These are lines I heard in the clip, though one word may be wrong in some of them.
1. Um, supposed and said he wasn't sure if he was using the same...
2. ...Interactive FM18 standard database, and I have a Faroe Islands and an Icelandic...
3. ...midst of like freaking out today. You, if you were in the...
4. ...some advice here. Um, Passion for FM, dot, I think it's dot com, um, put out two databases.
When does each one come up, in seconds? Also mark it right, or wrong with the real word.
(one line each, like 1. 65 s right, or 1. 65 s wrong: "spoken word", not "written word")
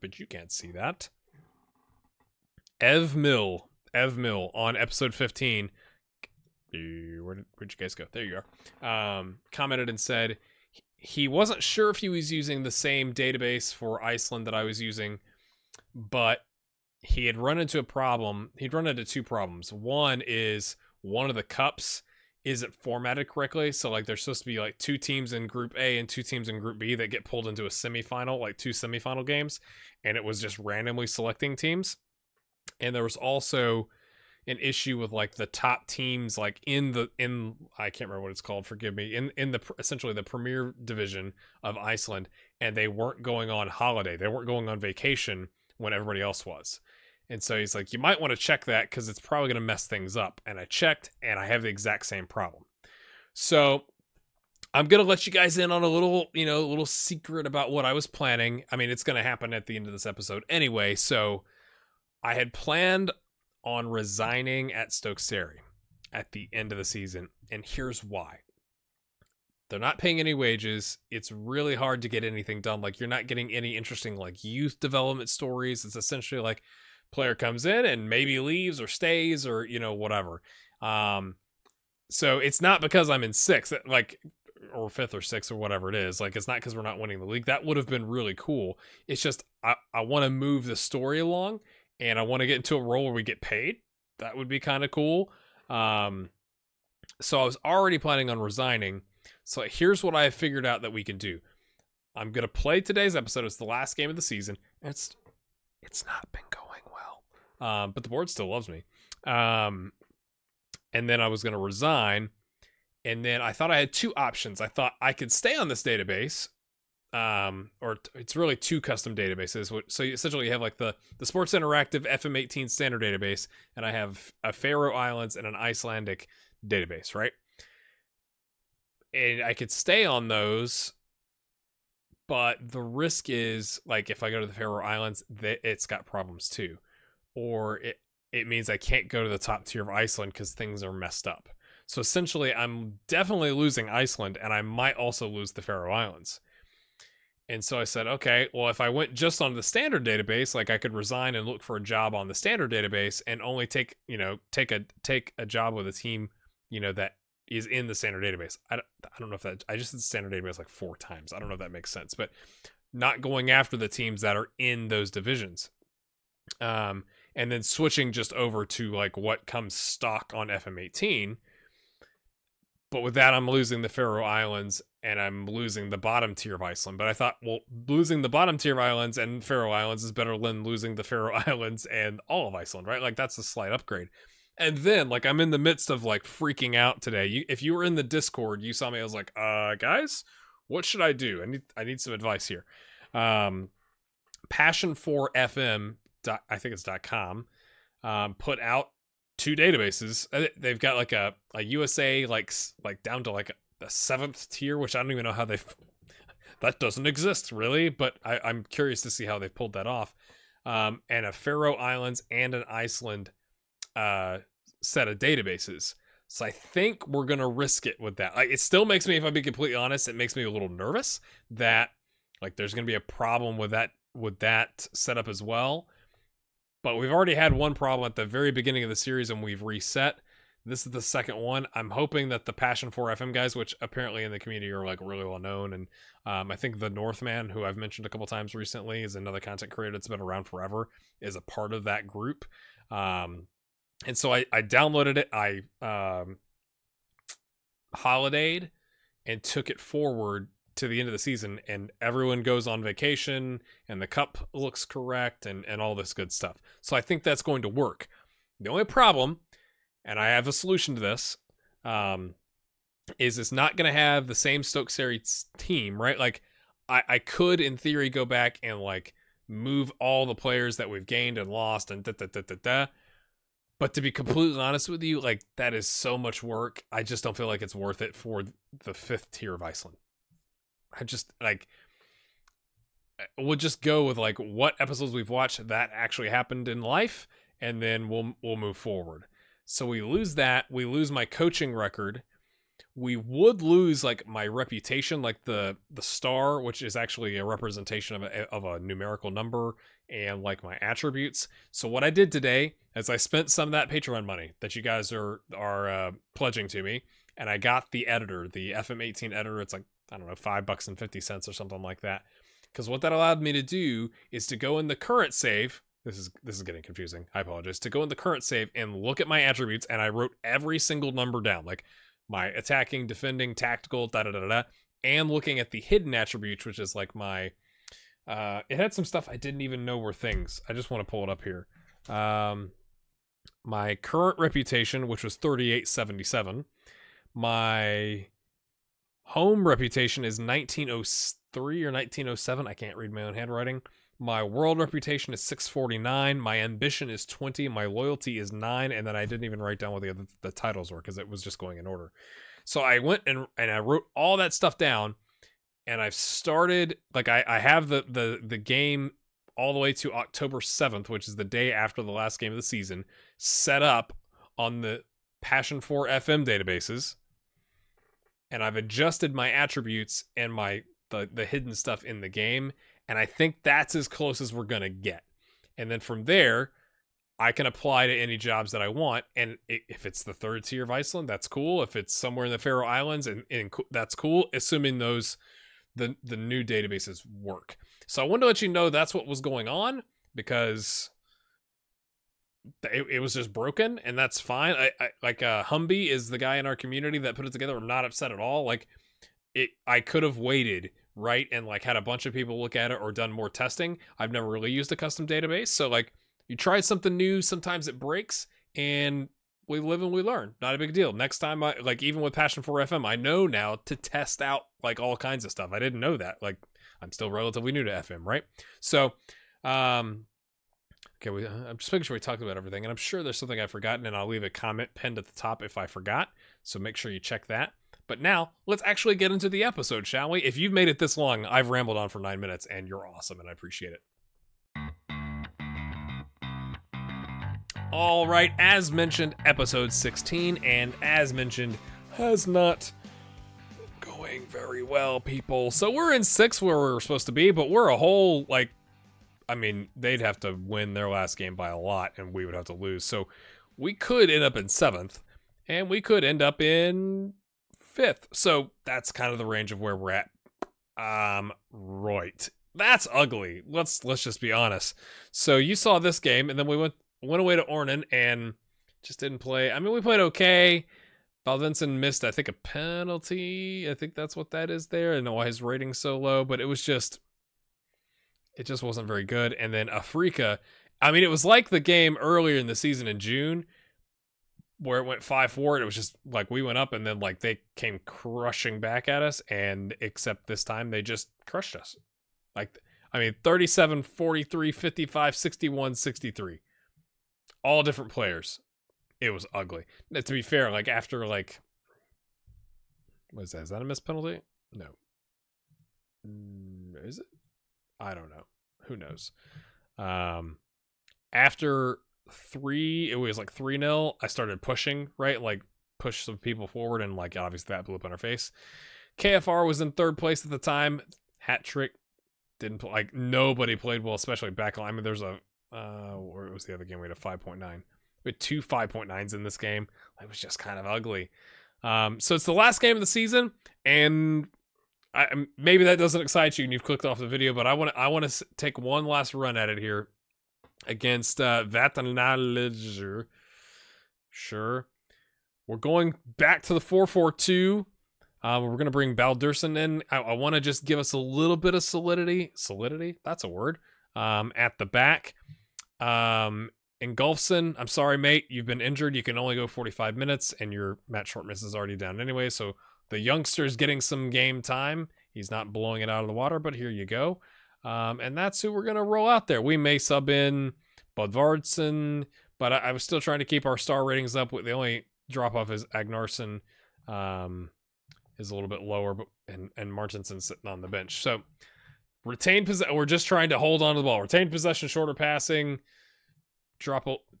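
1. 9 s wrong: "commented", not "supposed"
2. 121 s right
3. 185 s right
4. 191 s right.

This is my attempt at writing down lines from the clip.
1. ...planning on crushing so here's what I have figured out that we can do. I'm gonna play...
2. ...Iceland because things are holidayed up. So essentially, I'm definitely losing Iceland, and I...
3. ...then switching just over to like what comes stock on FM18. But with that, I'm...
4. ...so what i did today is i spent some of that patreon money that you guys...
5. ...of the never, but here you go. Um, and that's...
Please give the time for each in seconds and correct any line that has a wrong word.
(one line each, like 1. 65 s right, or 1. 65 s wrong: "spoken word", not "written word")
1. 97 s wrong: "resigning", not "crushing"
2. 139 s wrong: "messed", not "holidayed"
3. 167 s right
4. 301 s right
5. 566 s wrong: "water", not "never".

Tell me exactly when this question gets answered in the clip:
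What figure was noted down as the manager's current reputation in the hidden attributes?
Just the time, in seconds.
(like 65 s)
335 s.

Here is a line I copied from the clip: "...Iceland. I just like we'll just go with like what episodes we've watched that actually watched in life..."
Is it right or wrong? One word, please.
wrong.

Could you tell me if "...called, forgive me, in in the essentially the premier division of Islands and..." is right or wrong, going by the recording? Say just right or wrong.
wrong.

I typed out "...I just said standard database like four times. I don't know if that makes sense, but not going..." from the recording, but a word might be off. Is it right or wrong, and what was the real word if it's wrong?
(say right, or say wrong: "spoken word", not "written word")
right.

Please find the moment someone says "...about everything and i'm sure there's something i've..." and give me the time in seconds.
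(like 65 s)
422 s.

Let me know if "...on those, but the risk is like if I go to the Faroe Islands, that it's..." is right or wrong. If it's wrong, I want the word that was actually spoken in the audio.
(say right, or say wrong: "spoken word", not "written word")
right.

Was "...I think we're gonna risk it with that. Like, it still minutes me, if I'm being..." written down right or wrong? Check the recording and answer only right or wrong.
wrong.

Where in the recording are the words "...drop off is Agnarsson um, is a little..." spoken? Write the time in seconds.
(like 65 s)
575 s.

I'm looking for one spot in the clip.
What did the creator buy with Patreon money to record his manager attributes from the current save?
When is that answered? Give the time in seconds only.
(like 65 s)
308 s.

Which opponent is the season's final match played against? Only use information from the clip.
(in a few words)
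Vatanalidzer.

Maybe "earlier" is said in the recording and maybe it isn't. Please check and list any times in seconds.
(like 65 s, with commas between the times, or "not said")
482 s.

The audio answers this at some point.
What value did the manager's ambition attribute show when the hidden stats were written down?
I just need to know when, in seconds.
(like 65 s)
347 s.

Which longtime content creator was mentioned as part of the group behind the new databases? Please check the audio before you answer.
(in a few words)
the Northman.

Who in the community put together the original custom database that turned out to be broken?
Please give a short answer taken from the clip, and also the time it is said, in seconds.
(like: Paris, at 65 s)
Humby, at 395 s.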